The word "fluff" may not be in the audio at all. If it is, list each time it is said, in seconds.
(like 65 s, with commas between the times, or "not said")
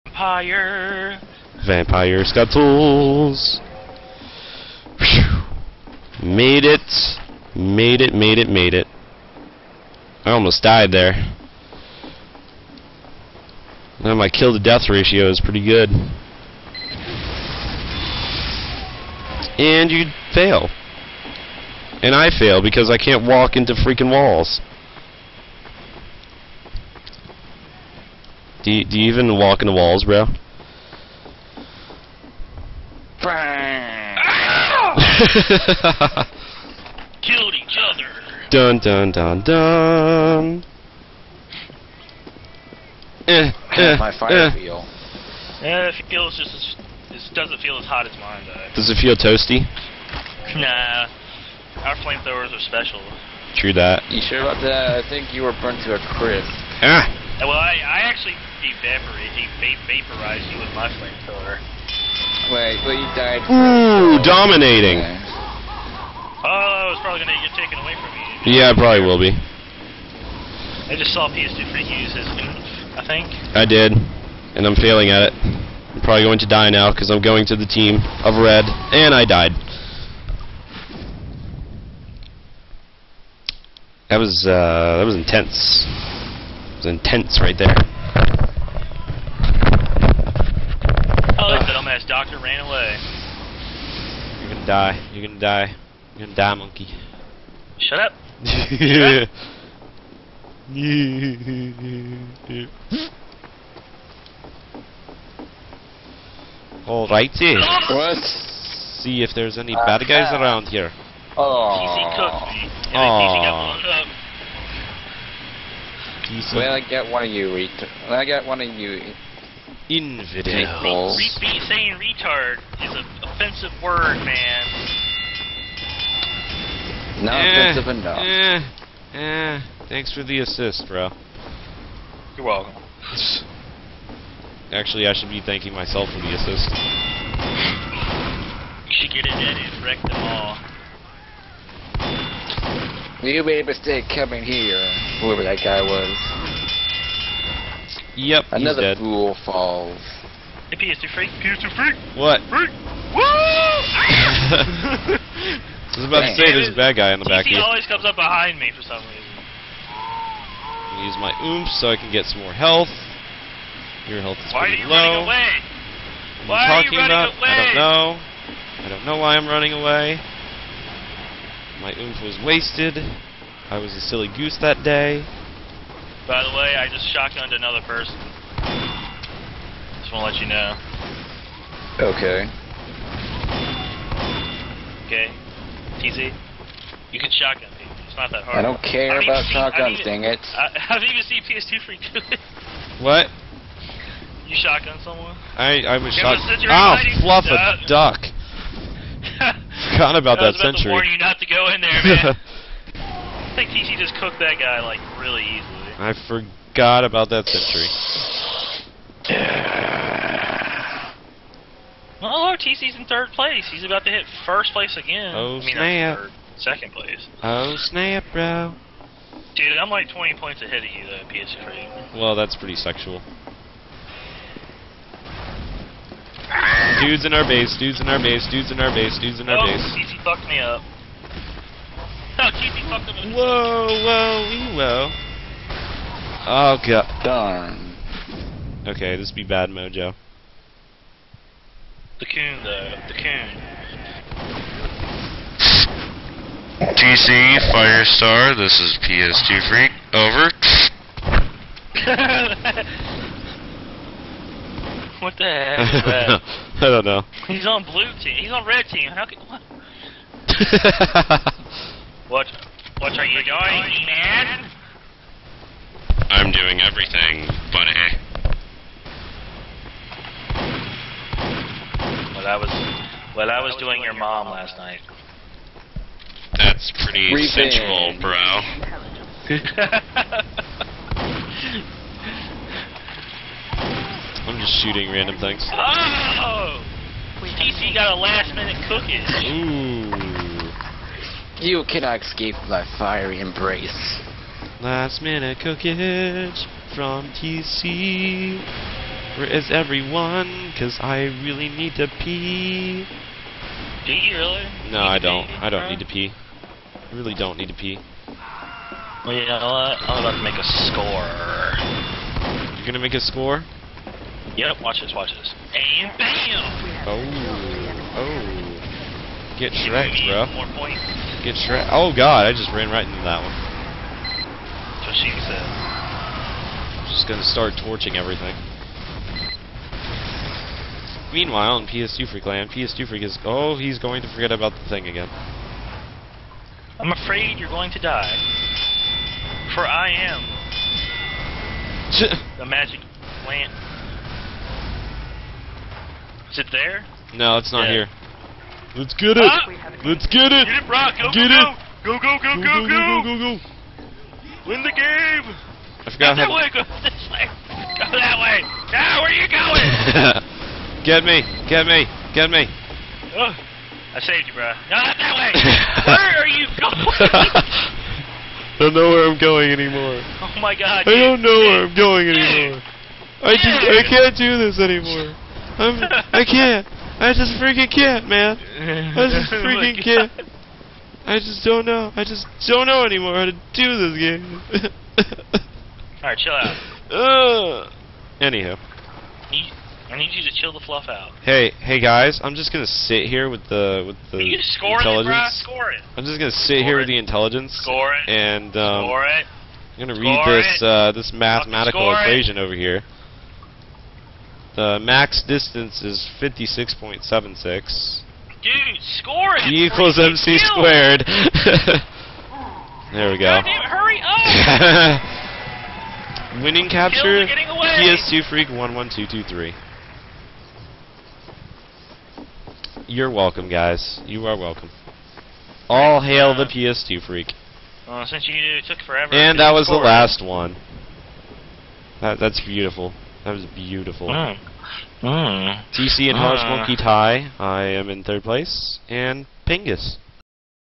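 197 s, 390 s.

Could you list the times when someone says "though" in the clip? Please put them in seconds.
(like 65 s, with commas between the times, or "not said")
48 s, 221 s, 242 s.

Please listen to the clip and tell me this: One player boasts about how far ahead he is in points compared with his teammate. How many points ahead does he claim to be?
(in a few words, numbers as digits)
20.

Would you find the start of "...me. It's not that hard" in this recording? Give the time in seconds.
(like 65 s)
187 s.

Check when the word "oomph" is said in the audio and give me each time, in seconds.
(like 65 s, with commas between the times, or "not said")
161 s, 171 s.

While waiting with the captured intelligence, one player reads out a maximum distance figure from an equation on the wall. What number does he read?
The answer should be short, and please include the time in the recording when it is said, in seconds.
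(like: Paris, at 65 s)
56.76, at 406 s.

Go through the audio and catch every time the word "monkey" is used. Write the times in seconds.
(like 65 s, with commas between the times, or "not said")
96 s, 436 s.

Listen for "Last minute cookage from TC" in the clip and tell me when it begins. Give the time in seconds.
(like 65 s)
294 s.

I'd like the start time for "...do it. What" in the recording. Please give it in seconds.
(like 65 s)
192 s.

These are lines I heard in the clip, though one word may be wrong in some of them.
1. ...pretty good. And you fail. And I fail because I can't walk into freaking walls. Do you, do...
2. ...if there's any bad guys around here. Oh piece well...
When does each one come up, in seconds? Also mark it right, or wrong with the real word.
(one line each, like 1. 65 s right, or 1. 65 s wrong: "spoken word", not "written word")
1. 15 s right
2. 109 s right.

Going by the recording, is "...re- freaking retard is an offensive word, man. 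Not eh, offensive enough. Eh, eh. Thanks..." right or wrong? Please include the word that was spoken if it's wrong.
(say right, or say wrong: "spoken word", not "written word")
wrong: "saying", not "freaking".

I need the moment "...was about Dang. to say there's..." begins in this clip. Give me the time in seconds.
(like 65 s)
155 s.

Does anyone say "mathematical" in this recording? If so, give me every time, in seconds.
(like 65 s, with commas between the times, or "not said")
401 s.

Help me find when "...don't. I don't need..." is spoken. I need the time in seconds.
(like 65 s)
305 s.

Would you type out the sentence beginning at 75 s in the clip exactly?
I'm probably going to die now because I'm going to the team of red, and I died.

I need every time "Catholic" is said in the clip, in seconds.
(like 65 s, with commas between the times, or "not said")
not said.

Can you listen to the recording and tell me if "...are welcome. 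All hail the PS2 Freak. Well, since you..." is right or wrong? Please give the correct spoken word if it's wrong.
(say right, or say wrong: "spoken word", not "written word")
right.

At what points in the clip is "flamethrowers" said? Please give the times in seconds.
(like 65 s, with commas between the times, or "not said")
51 s, 60 s.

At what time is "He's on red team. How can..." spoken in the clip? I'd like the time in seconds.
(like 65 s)
258 s.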